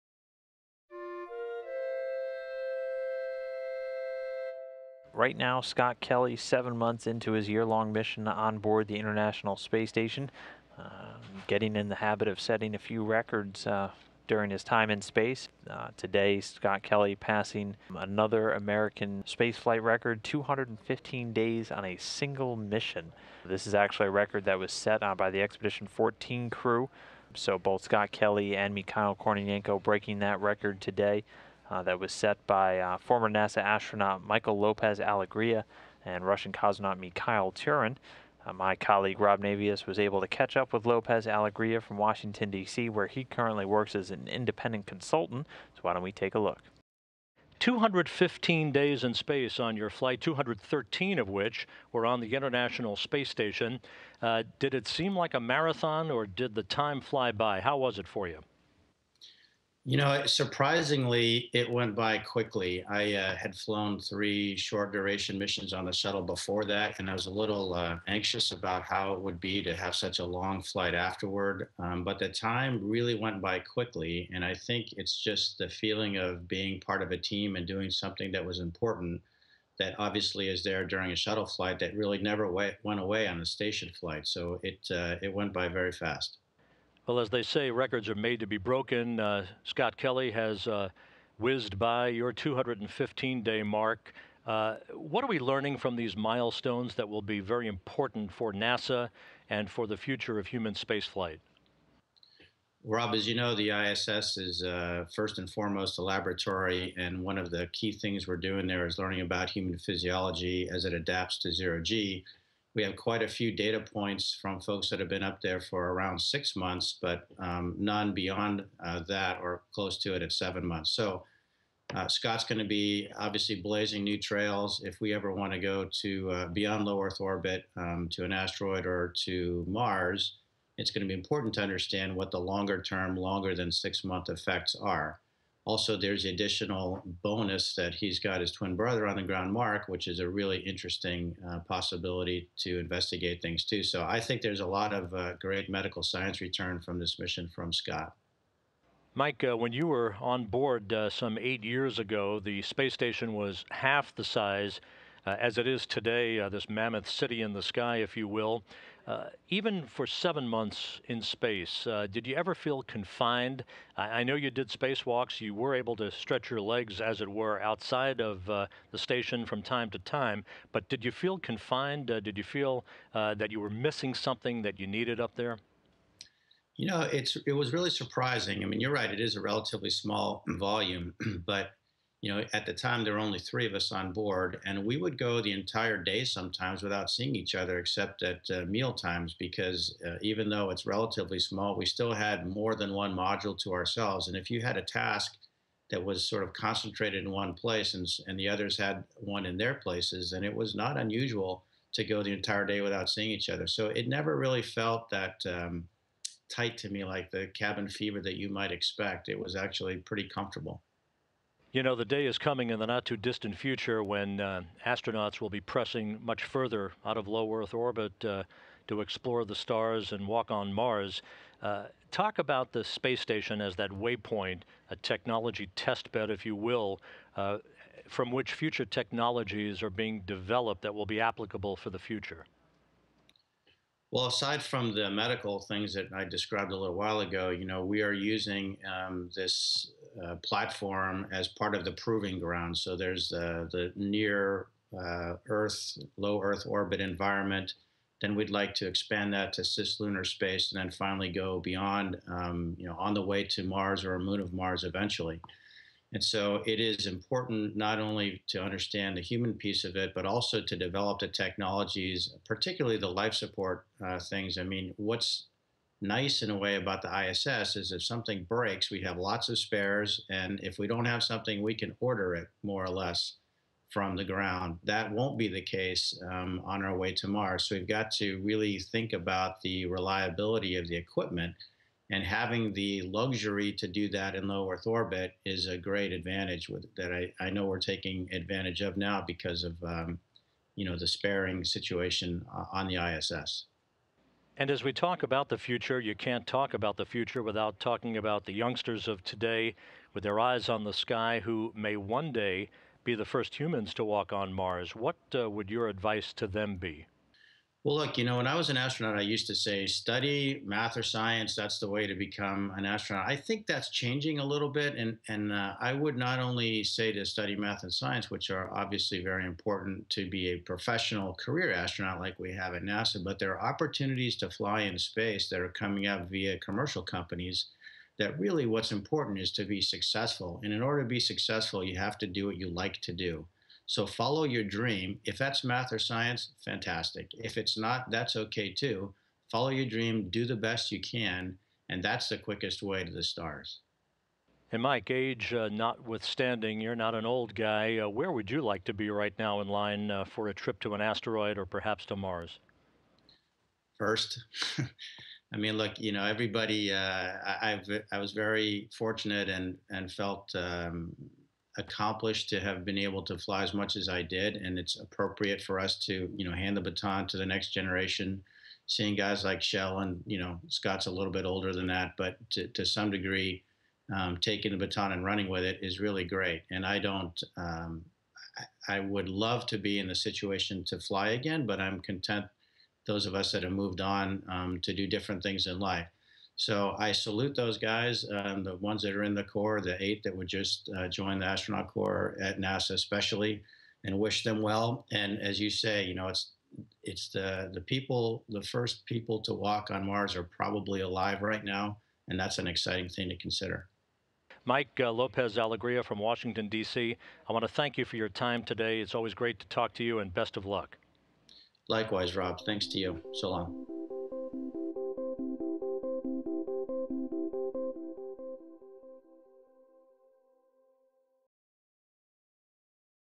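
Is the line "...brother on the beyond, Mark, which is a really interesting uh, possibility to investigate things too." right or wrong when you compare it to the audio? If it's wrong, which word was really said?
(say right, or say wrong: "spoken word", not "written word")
wrong: "ground", not "beyond".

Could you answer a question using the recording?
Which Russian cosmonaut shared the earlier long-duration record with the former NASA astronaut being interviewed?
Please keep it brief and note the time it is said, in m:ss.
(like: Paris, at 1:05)
Mikhail Tyurin, at 0:36.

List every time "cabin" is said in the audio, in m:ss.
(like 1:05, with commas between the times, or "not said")
3:27.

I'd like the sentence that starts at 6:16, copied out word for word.
And I don't, um, I, would love to be in the situation to fly again, but I'm content.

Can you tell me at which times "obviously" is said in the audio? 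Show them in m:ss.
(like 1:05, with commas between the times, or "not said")
1:19, 2:03, 5:18.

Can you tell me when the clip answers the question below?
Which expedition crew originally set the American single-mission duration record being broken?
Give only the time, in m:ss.
0:25.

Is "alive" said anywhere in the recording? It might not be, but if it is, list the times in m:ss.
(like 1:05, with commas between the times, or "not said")
6:41.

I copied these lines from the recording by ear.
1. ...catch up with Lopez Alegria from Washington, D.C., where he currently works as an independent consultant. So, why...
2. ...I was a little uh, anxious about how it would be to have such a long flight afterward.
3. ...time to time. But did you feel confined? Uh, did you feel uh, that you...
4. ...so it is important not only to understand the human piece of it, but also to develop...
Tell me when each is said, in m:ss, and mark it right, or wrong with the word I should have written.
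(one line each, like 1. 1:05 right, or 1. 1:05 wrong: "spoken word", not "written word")
1. 0:40 right
2. 1:07 right
3. 2:49 right
4. 4:16 right.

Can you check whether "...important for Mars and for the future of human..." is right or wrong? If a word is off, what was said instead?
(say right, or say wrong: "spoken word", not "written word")
wrong: "NASA", not "Mars".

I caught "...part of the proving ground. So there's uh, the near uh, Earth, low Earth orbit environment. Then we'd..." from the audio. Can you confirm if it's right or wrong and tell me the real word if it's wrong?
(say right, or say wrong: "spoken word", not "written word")
right.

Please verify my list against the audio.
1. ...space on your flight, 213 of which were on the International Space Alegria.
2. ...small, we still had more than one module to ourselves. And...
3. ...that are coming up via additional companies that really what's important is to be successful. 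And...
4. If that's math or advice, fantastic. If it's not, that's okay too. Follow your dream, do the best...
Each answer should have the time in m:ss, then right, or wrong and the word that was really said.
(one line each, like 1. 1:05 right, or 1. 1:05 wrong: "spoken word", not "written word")
1. 0:49 wrong: "Station", not "Alegria"
2. 3:11 right
3. 5:25 wrong: "commercial", not "additional"
4. 5:35 wrong: "science", not "advice".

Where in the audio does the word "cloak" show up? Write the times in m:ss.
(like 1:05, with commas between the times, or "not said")
not said.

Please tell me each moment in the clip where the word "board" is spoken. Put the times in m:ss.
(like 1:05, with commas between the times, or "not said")
0:08, 2:30, 3:04.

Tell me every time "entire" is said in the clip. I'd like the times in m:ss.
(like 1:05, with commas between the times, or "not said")
3:05, 3:22.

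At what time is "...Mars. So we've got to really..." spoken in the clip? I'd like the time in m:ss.
4:37.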